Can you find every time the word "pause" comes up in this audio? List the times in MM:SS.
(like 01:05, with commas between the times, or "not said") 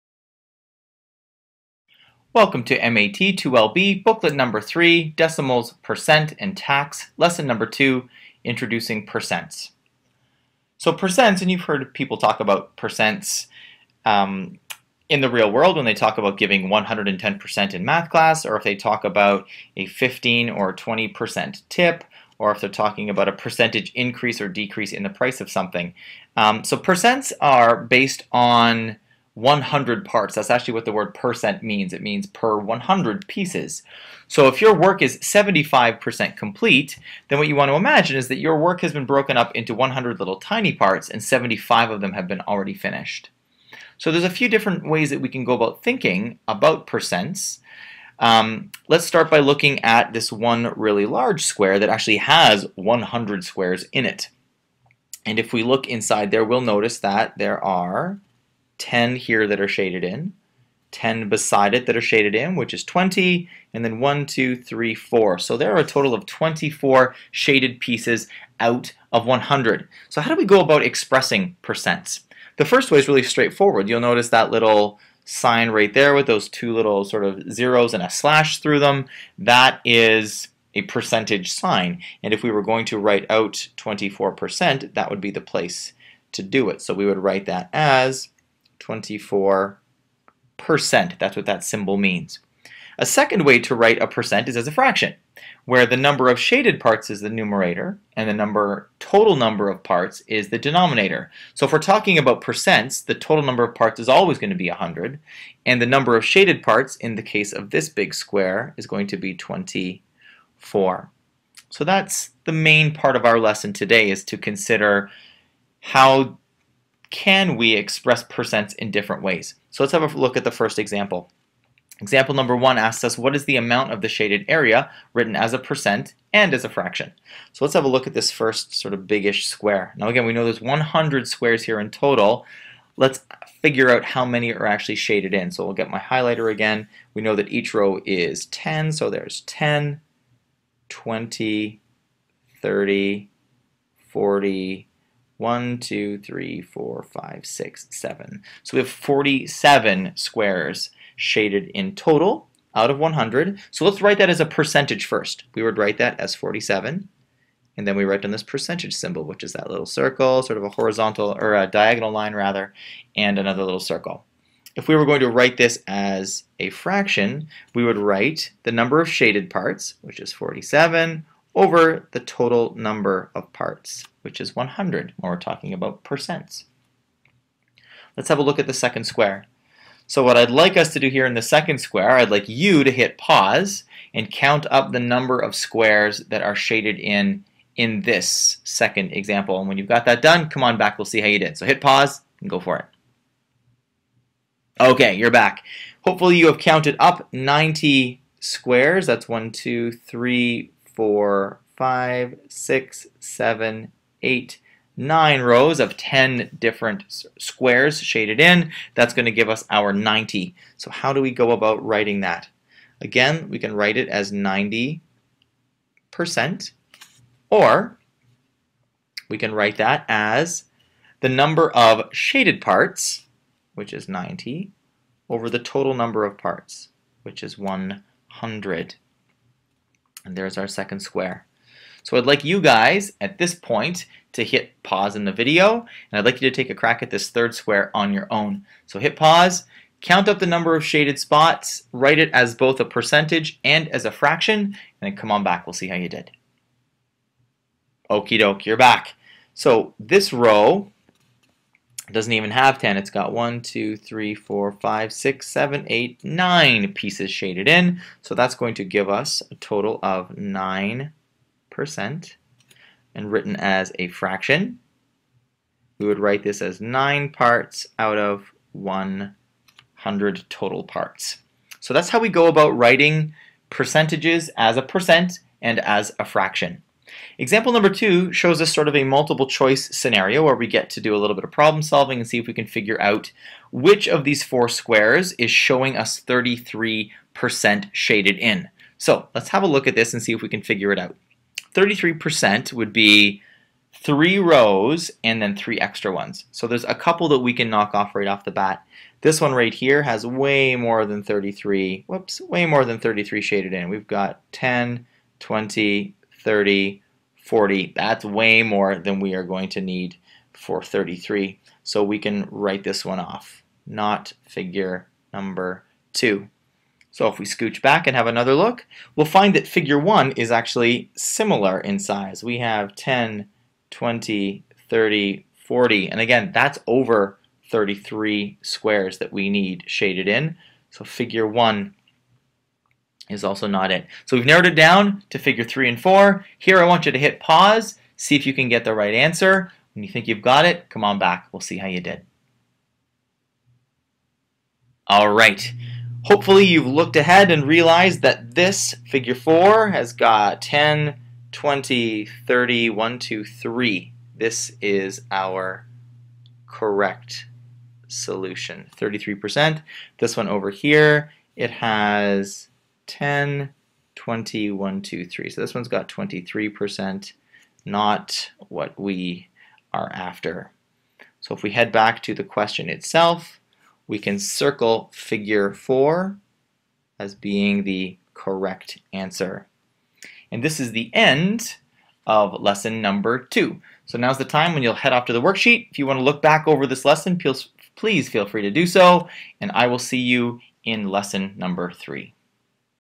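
03:03, 03:11, 03:54, 03:59, 05:37.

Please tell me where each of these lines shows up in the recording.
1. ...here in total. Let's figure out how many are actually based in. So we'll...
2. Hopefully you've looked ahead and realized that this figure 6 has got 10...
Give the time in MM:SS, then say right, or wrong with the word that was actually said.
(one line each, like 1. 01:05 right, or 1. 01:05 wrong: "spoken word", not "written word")
1. 02:11 wrong: "shaded", not "based"
2. 05:46 wrong: "4", not "6".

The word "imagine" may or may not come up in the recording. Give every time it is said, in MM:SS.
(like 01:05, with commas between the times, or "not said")
00:37.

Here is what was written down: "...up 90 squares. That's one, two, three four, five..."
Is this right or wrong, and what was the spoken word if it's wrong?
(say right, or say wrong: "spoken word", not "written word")
right.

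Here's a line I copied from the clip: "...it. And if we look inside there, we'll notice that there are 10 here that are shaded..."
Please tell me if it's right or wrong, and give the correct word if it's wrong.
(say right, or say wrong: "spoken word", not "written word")
right.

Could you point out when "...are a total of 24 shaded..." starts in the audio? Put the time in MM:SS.
01:05.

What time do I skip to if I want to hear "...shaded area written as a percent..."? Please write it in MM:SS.
02:04.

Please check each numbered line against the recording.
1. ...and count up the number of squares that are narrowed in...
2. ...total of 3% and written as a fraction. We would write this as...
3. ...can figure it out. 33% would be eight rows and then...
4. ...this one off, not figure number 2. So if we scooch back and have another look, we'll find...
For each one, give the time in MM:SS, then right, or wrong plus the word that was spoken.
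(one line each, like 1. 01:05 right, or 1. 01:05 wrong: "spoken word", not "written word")
1. 03:04 wrong: "shaded", not "narrowed"
2. 04:19 wrong: "9", not "3"
3. 04:50 wrong: "three", not "eight"
4. 05:12 right.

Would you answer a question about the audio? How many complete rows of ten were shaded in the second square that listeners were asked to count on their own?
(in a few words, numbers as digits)
9.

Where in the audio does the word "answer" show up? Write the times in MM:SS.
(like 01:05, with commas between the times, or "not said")
05:39, 06:19.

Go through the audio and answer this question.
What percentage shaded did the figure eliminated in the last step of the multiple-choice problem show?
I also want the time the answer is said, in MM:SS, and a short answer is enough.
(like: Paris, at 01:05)
23%, at 06:06.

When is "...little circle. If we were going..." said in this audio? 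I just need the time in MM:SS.
02:43.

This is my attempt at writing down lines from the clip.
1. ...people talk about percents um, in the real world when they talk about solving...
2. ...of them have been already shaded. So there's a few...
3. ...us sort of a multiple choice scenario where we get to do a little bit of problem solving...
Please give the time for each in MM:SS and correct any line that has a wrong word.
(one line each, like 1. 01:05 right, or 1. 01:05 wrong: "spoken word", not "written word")
1. 00:11 wrong: "giving", not "solving"
2. 00:41 wrong: "finished", not "shaded"
3. 04:38 right.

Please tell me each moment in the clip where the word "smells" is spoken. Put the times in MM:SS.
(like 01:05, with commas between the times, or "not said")
not said.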